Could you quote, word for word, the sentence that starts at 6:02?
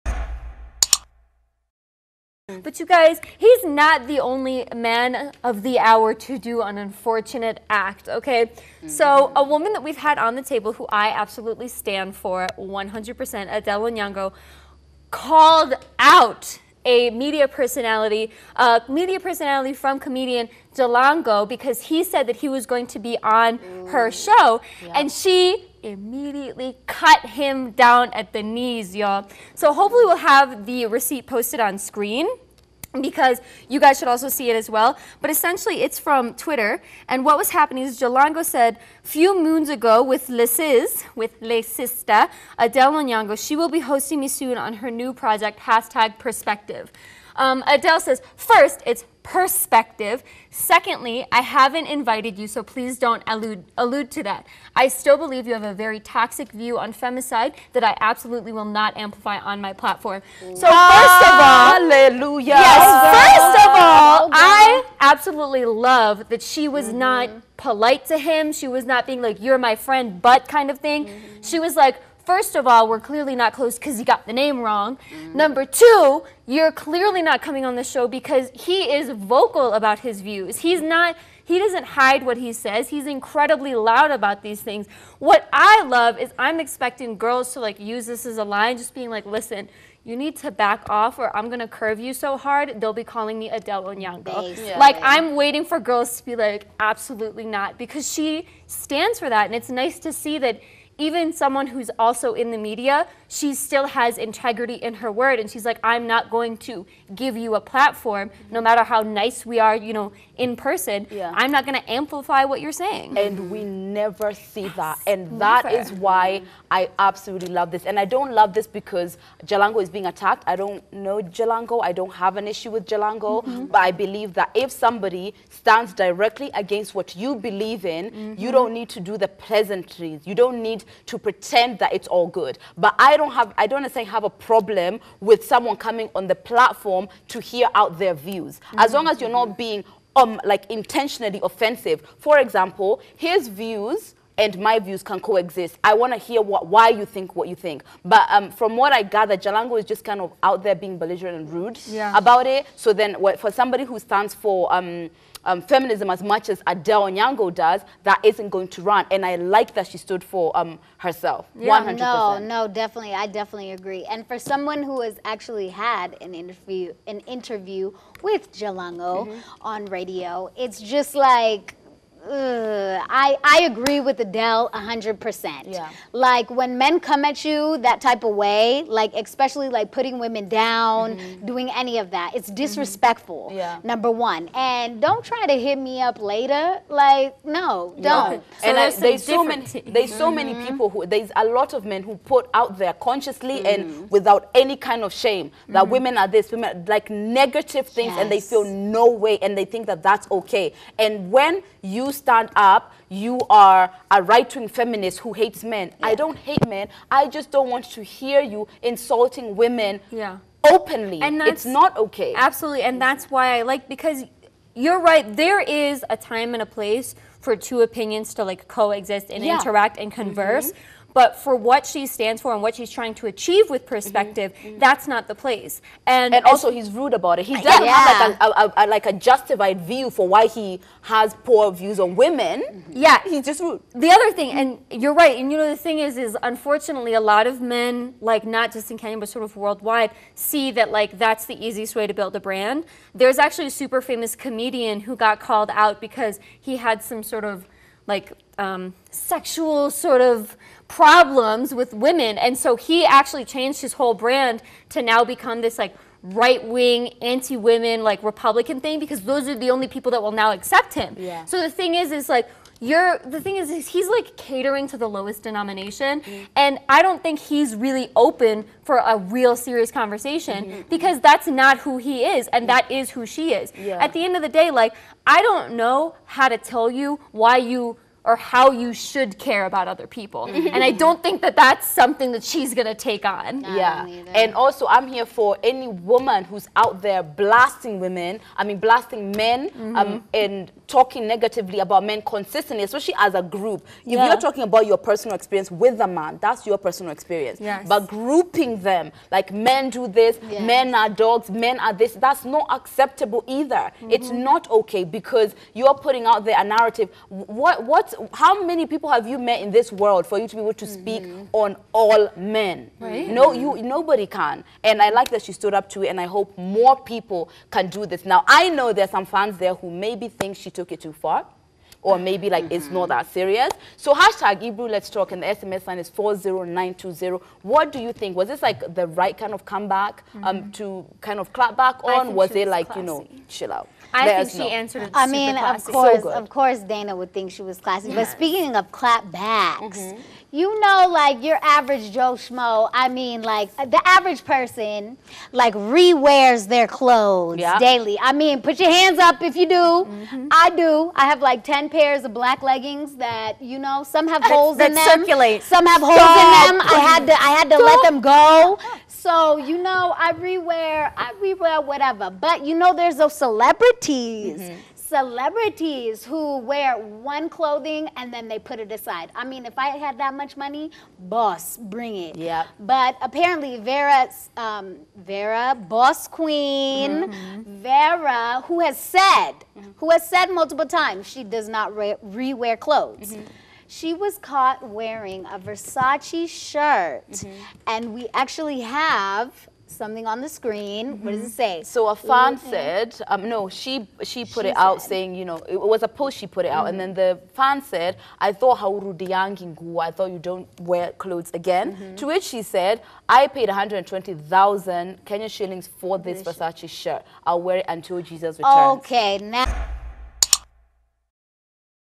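But, you know, there's those celebrities.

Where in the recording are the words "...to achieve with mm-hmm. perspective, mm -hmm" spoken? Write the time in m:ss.
3:43.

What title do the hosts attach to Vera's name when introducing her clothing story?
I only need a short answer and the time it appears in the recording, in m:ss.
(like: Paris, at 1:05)
boss queen, at 6:15.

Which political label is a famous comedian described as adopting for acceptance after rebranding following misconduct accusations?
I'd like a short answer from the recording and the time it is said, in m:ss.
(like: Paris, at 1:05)
Republican, at 4:18.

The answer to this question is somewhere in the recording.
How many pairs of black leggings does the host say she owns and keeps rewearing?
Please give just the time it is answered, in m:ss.
5:51.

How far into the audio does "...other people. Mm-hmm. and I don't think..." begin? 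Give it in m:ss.
4:39.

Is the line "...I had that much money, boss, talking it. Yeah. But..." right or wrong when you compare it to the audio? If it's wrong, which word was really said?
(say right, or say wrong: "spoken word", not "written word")
wrong: "bring", not "talking".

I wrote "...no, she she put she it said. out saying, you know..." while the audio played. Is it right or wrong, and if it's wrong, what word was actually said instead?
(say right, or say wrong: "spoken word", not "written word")
right.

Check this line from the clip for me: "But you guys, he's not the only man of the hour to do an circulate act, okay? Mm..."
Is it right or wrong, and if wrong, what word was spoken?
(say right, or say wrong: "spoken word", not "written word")
wrong: "unfortunate", not "circulate".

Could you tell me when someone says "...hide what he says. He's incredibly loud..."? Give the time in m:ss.
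1:21.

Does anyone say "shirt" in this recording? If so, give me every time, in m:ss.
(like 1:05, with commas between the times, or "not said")
6:26, 6:46.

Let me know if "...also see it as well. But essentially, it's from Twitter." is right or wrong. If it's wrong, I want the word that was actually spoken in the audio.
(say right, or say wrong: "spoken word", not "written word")
right.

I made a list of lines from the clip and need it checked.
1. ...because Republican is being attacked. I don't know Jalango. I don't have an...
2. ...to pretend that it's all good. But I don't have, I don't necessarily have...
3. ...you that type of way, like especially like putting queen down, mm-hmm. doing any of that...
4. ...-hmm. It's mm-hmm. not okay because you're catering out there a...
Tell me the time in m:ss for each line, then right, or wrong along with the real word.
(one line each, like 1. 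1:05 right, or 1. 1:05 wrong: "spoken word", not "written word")
1. 1:58 wrong: "Jalango", not "Republican"
2. 2:11 right
3. 2:57 wrong: "women", not "queen"
4. 5:03 wrong: "putting", not "catering".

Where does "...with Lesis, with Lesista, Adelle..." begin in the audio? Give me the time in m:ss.
0:40.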